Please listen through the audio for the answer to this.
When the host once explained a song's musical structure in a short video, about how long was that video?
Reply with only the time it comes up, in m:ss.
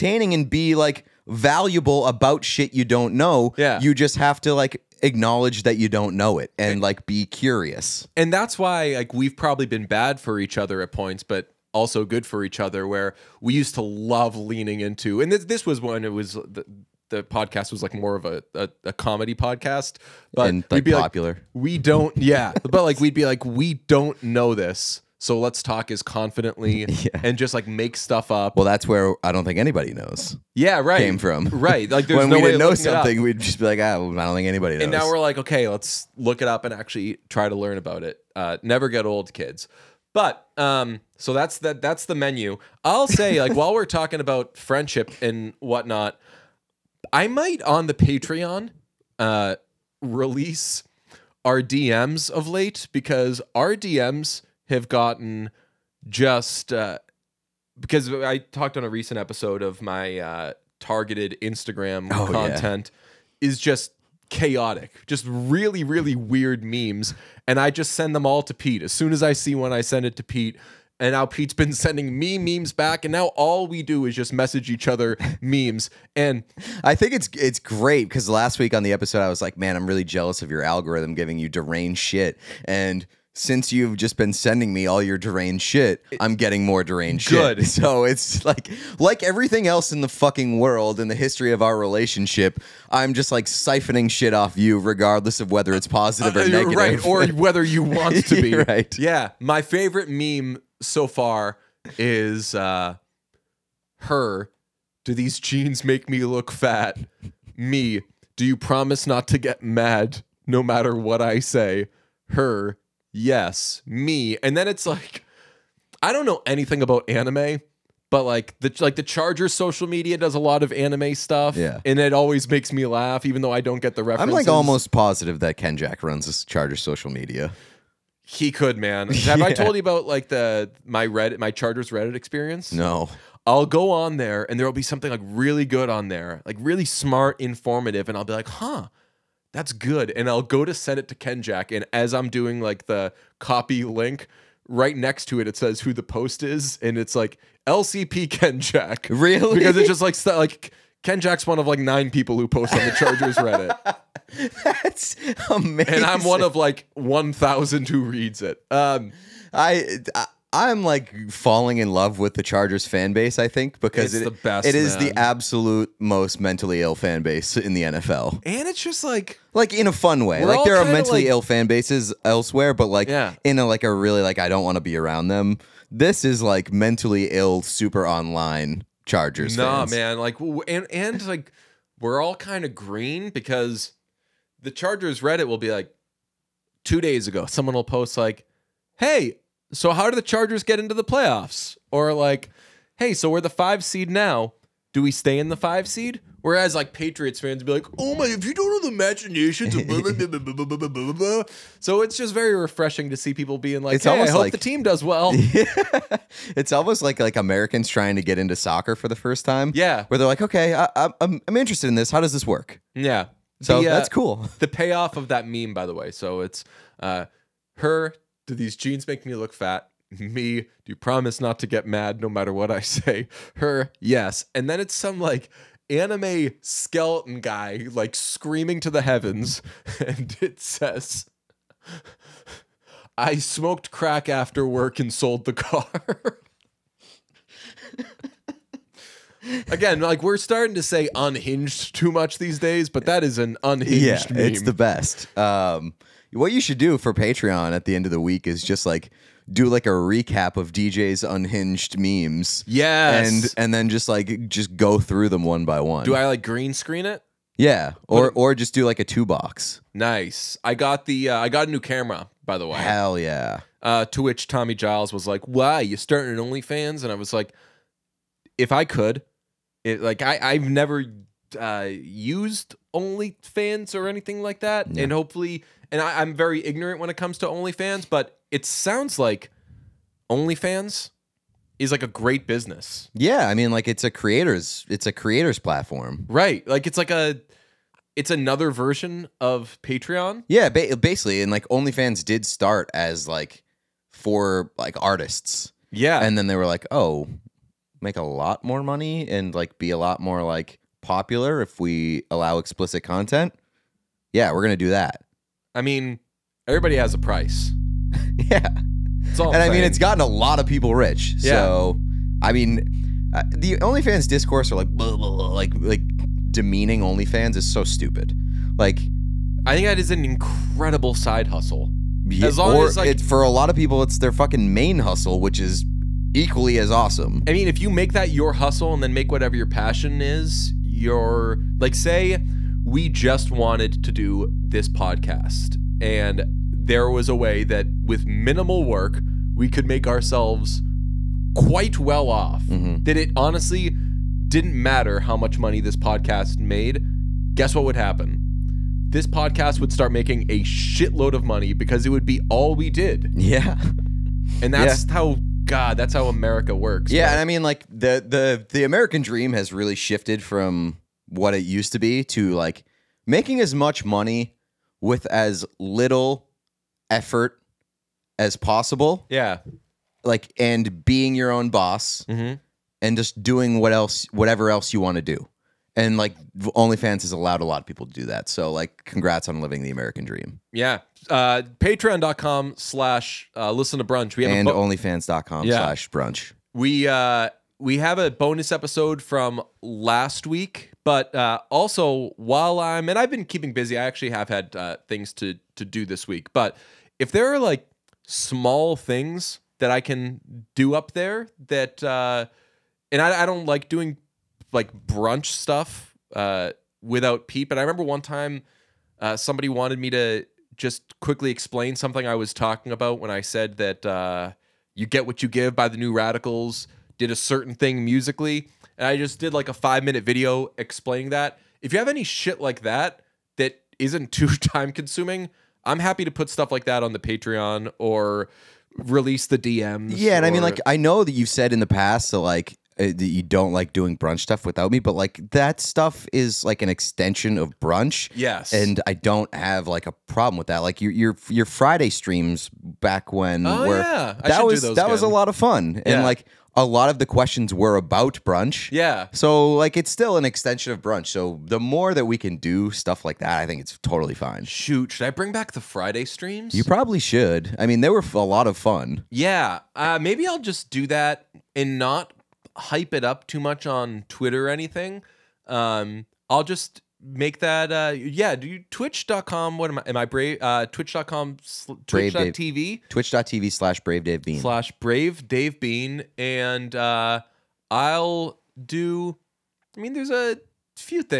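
6:59.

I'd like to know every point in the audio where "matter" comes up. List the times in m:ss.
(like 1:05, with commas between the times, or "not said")
1:50, 3:42, 5:44.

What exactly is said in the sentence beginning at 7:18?
Yes, and I don't have like a problem with that.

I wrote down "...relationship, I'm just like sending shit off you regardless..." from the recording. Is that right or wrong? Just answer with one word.
wrong.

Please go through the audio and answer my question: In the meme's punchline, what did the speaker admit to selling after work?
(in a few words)
the car.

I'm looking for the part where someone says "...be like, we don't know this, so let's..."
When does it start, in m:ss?
0:23.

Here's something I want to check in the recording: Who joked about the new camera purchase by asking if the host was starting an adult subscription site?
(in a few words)
Tommy Giles.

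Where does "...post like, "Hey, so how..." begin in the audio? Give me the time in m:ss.
3:07.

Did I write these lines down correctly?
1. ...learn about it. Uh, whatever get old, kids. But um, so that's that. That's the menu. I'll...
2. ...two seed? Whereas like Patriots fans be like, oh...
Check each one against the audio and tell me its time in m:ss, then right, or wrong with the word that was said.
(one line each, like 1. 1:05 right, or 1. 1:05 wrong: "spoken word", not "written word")
1. 0:37 wrong: "never", not "whatever"
2. 3:15 wrong: "five", not "two".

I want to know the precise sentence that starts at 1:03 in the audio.
is just chaotic, just really, really weird memes.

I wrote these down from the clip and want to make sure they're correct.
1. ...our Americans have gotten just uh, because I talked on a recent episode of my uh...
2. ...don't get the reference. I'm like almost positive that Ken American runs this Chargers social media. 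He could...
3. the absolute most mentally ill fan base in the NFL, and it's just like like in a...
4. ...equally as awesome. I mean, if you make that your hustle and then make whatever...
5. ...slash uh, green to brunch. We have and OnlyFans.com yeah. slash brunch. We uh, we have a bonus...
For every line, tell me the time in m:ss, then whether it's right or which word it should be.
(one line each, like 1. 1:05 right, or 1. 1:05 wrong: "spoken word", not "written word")
1. 0:53 wrong: "DMs", not "Americans"
2. 2:03 wrong: "Jack", not "American"
3. 2:45 right
4. 5:26 right
5. 6:22 wrong: "listen", not "green".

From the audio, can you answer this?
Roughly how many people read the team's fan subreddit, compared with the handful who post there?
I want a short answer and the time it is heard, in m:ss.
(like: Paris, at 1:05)
1,000, at 2:36.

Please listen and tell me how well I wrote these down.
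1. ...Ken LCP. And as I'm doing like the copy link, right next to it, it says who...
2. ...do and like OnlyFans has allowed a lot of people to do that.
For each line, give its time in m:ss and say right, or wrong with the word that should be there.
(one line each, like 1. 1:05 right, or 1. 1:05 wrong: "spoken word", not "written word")
1. 2:21 wrong: "Jack", not "LCP"
2. 6:15 right.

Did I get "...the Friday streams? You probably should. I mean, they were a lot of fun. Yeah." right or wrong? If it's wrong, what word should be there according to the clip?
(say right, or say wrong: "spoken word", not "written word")
right.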